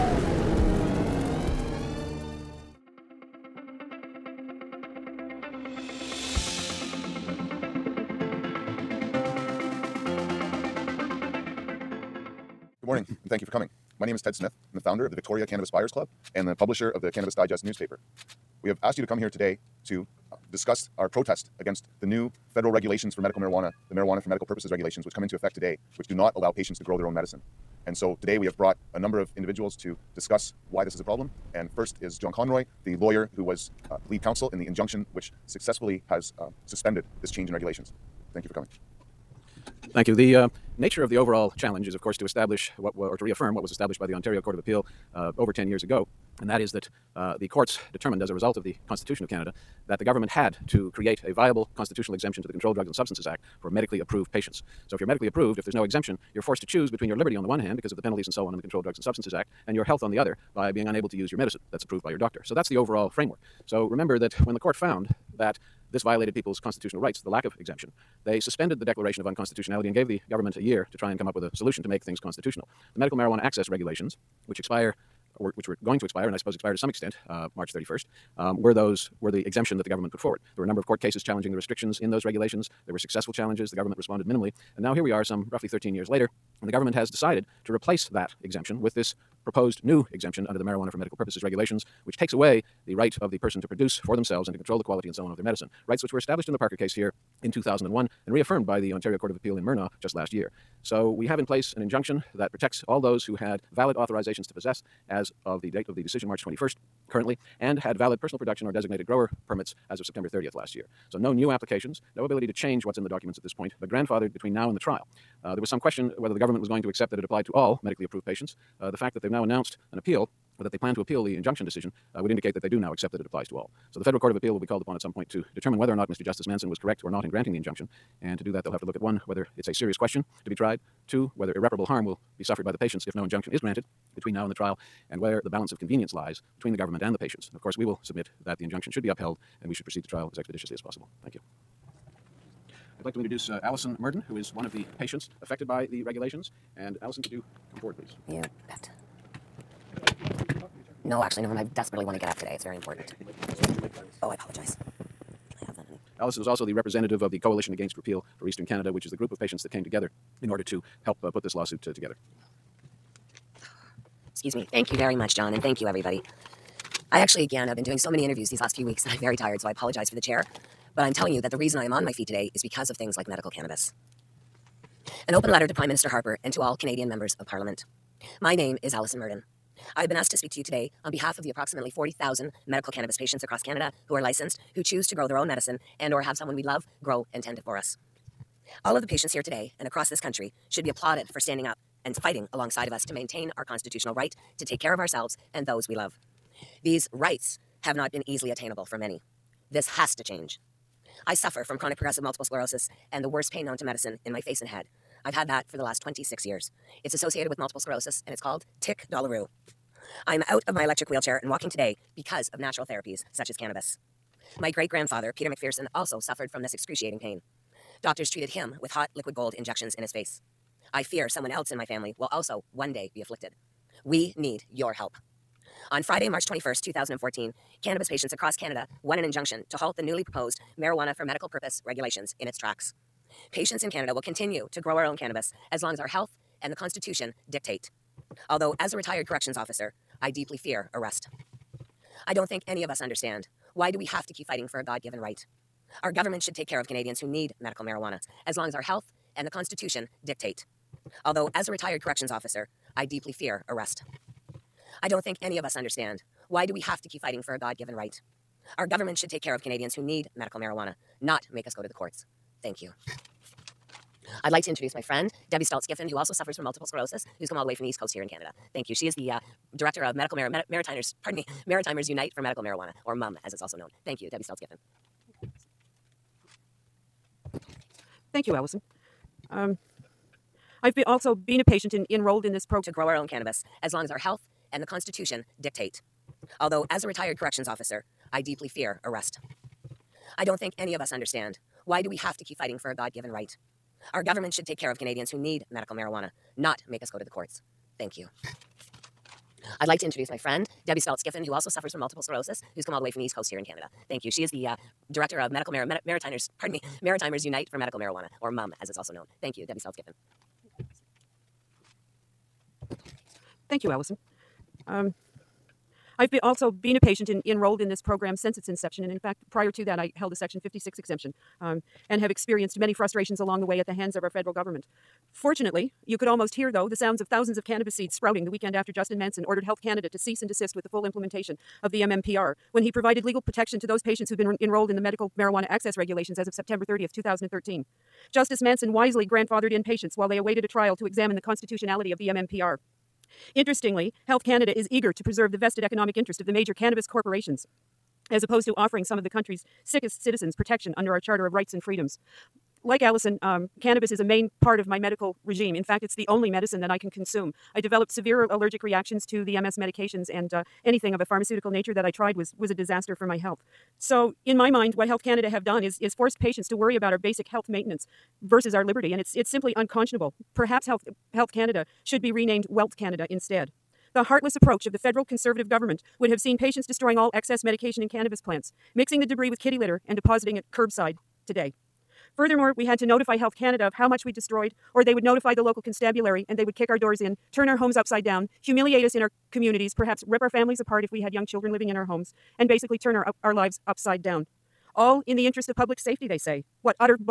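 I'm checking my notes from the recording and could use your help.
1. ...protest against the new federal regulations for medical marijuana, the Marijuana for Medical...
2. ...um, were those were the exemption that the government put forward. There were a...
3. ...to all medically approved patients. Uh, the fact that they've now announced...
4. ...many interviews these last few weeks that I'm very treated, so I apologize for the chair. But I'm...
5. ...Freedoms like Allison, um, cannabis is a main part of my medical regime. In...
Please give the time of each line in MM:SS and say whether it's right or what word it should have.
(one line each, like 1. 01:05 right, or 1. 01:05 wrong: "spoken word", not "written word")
1. 00:21 right
2. 01:18 right
3. 01:57 right
4. 02:48 wrong: "tired", not "treated"
5. 05:51 right.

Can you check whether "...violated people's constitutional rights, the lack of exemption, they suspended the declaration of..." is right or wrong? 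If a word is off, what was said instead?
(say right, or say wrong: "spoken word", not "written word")
right.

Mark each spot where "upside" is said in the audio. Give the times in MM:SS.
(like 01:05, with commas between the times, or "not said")
06:27, 06:33.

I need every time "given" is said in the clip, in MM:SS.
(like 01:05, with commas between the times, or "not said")
04:05, 04:17, 04:53.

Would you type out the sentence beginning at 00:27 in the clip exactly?
And so today we have brought a number of individuals to discuss why this is a problem.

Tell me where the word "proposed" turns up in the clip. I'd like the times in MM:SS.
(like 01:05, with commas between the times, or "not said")
01:29, 03:50.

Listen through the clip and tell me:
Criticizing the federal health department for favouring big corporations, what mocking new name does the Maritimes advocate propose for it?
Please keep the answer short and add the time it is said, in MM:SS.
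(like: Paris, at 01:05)
Wealth Canada, at 06:12.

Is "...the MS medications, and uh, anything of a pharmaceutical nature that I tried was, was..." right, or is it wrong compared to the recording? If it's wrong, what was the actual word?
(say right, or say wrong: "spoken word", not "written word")
right.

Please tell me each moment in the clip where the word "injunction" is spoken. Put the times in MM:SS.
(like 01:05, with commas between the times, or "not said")
00:34, 01:41, 02:01, 02:07, 02:13, 02:18, 03:49.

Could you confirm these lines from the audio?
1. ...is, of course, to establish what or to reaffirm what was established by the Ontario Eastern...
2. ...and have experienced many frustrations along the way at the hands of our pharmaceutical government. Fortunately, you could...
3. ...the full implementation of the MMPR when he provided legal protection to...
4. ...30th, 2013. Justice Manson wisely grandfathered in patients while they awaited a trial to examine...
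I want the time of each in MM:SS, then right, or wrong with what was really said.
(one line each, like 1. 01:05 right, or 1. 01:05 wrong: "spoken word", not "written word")
1. 00:41 wrong: "Court", not "Eastern"
2. 05:22 wrong: "federal", not "pharmaceutical"
3. 05:30 right
4. 05:36 right.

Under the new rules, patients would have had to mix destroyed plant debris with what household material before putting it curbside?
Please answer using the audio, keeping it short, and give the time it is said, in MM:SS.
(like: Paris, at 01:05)
Kitty litter, at 06:19.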